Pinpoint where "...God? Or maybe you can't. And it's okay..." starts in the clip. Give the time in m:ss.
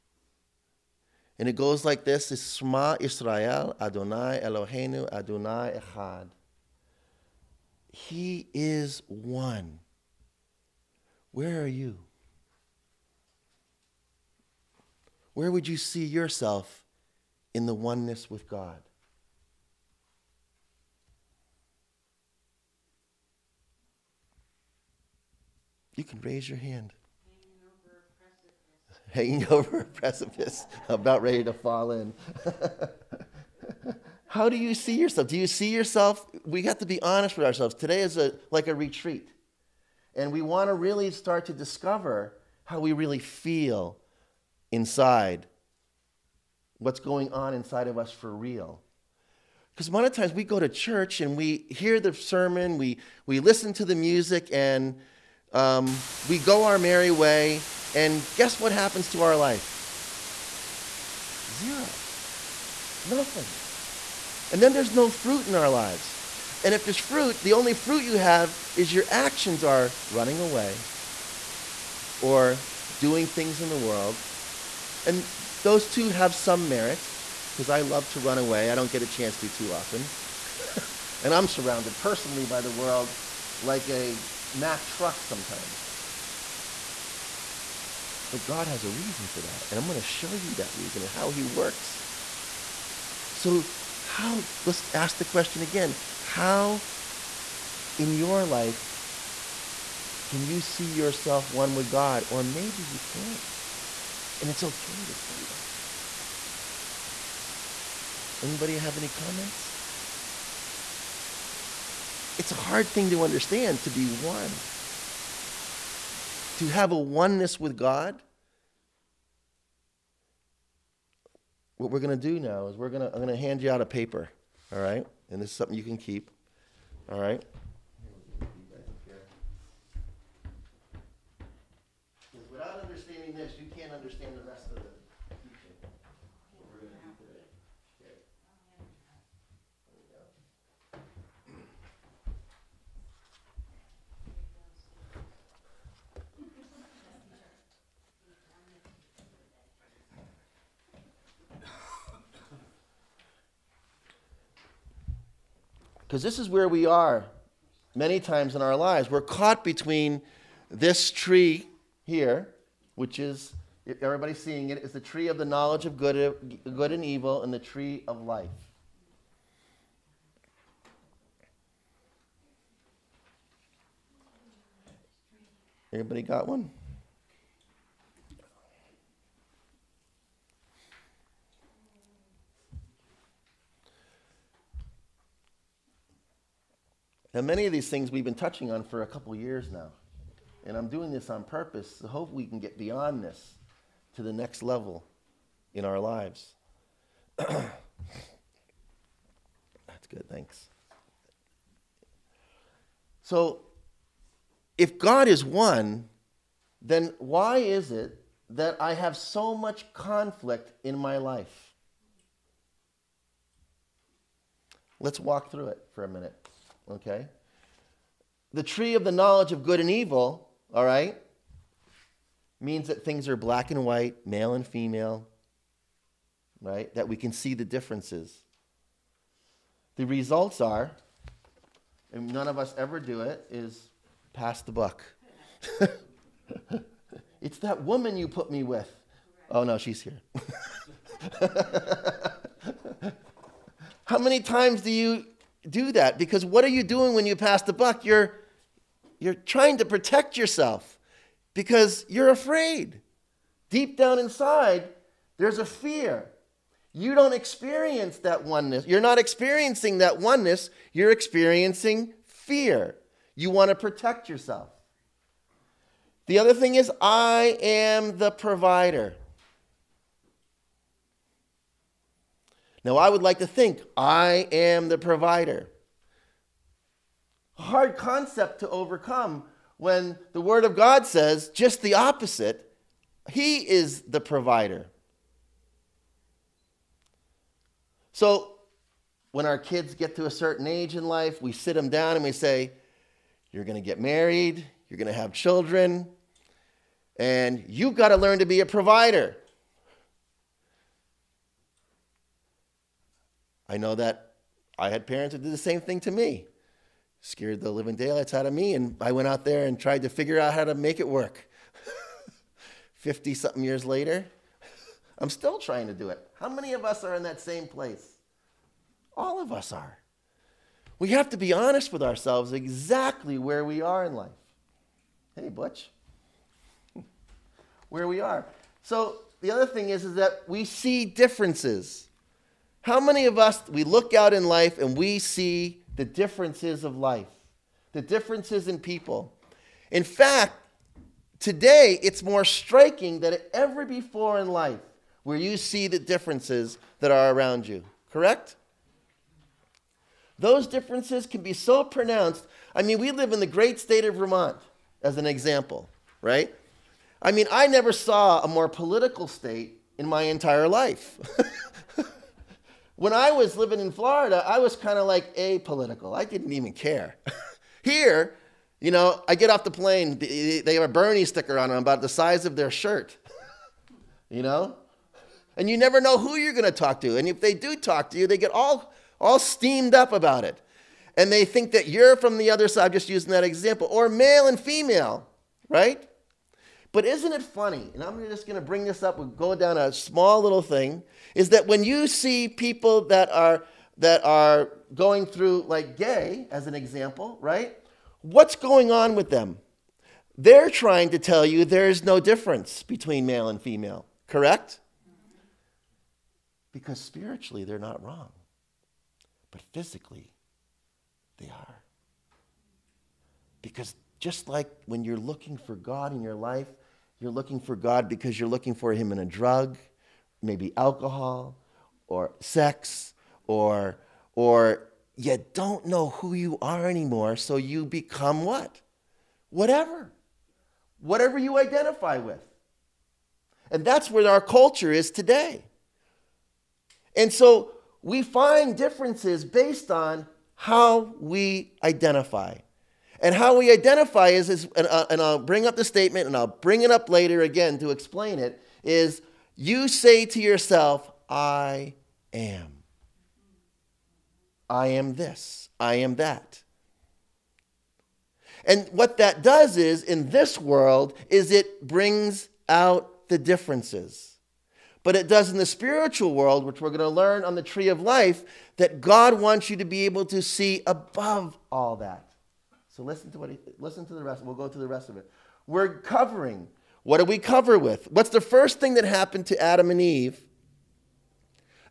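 1:41.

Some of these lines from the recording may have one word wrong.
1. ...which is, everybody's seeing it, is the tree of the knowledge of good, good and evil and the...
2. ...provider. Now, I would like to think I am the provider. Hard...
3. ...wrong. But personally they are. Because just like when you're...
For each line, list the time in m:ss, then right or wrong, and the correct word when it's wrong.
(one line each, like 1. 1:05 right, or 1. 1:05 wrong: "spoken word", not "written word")
1. 2:42 right
2. 4:28 right
3. 6:48 wrong: "physically", not "personally".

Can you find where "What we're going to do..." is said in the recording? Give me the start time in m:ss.
2:01.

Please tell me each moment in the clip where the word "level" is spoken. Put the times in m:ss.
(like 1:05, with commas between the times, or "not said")
3:14.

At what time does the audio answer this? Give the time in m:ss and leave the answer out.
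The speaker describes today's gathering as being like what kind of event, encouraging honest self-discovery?
0:38.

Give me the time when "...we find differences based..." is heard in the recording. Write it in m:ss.
7:18.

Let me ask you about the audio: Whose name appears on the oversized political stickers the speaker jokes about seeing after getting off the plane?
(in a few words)
Bernie.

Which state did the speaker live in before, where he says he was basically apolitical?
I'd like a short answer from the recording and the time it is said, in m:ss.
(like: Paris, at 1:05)
Florida, at 6:03.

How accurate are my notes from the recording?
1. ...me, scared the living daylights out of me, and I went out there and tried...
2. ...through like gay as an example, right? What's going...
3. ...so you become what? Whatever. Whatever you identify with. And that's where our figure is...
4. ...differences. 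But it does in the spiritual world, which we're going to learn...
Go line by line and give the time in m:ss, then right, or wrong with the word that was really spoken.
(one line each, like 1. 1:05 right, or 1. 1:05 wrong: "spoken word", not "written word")
1. 5:06 right
2. 6:35 right
3. 7:07 wrong: "culture", not "figure"
4. 7:43 right.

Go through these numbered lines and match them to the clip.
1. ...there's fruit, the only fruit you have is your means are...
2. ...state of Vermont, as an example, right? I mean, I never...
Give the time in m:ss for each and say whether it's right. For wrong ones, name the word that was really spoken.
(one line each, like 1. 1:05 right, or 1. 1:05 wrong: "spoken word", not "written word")
1. 1:06 wrong: "actions", not "means"
2. 5:53 right.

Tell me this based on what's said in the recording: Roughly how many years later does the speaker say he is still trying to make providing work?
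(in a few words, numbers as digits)
50 something.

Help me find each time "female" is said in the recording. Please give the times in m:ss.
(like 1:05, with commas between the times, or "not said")
3:44, 6:24, 6:43.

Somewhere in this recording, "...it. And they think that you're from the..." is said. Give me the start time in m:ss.
6:20.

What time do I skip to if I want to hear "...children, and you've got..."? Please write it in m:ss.
4:55.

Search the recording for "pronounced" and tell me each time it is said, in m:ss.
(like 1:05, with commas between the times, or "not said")
5:51.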